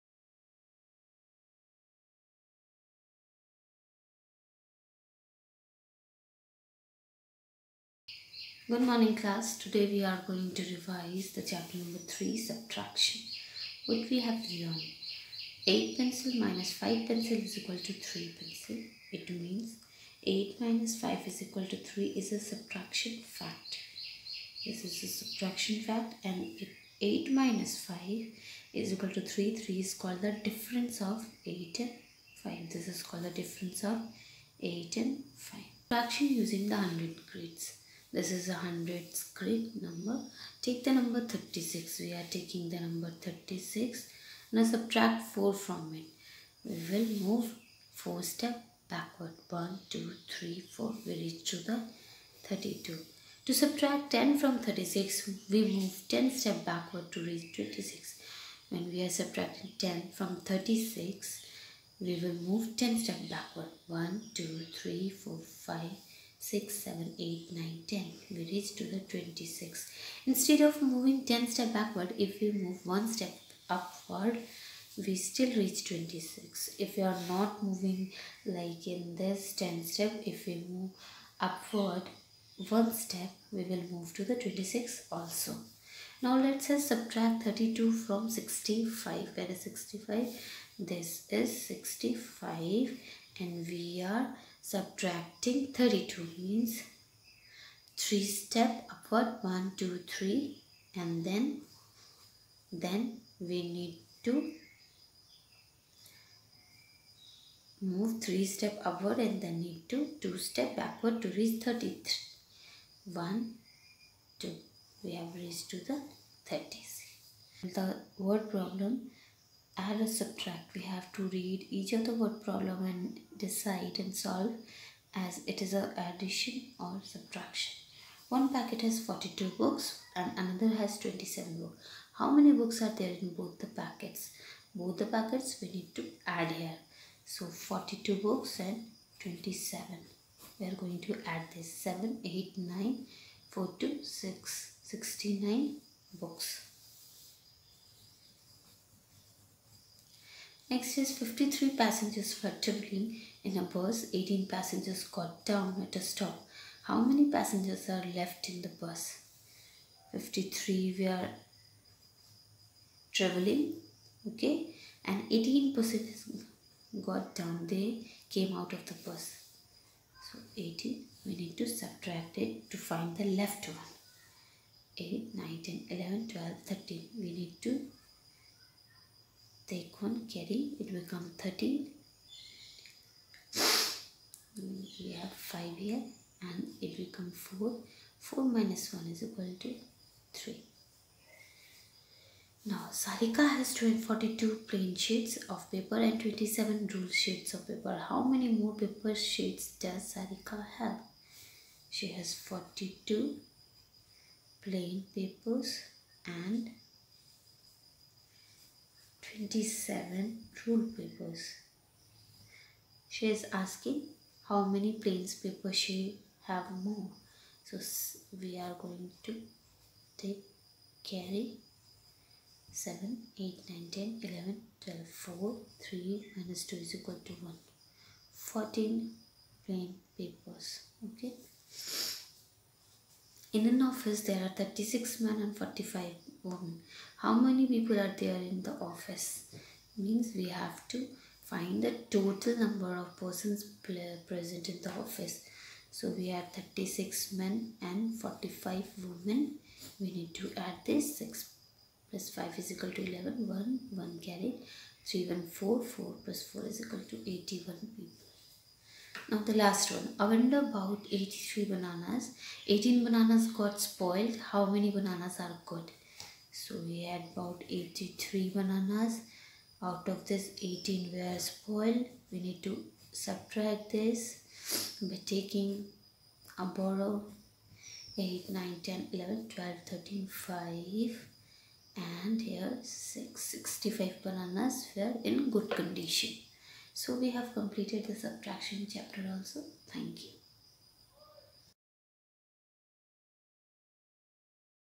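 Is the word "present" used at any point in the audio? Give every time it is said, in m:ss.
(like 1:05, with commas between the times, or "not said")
4:04.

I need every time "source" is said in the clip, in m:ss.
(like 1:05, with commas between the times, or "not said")
not said.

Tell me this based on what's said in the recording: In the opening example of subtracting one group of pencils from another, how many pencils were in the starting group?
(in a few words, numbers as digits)
8.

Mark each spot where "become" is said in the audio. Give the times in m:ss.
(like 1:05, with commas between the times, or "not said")
3:00, 3:07.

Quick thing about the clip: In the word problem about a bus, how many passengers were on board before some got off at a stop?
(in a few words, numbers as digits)
53.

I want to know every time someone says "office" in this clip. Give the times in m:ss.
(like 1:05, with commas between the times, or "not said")
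3:53, 3:58, 4:05.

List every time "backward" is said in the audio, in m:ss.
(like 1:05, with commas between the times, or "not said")
0:48, 0:56, 1:03, 1:11, 1:50.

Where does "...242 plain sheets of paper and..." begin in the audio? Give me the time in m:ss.
3:13.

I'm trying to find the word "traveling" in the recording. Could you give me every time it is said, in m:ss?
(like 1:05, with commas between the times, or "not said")
2:32, 2:43.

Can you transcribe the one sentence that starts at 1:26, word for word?
Now let's us subtract 32 from 65.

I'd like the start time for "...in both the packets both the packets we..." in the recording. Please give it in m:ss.
2:13.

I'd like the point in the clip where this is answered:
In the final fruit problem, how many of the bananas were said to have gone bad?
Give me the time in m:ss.
4:22.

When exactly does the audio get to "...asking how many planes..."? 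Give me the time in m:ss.
3:33.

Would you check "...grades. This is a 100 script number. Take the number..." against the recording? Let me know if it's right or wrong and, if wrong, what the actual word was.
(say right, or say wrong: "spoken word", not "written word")
right.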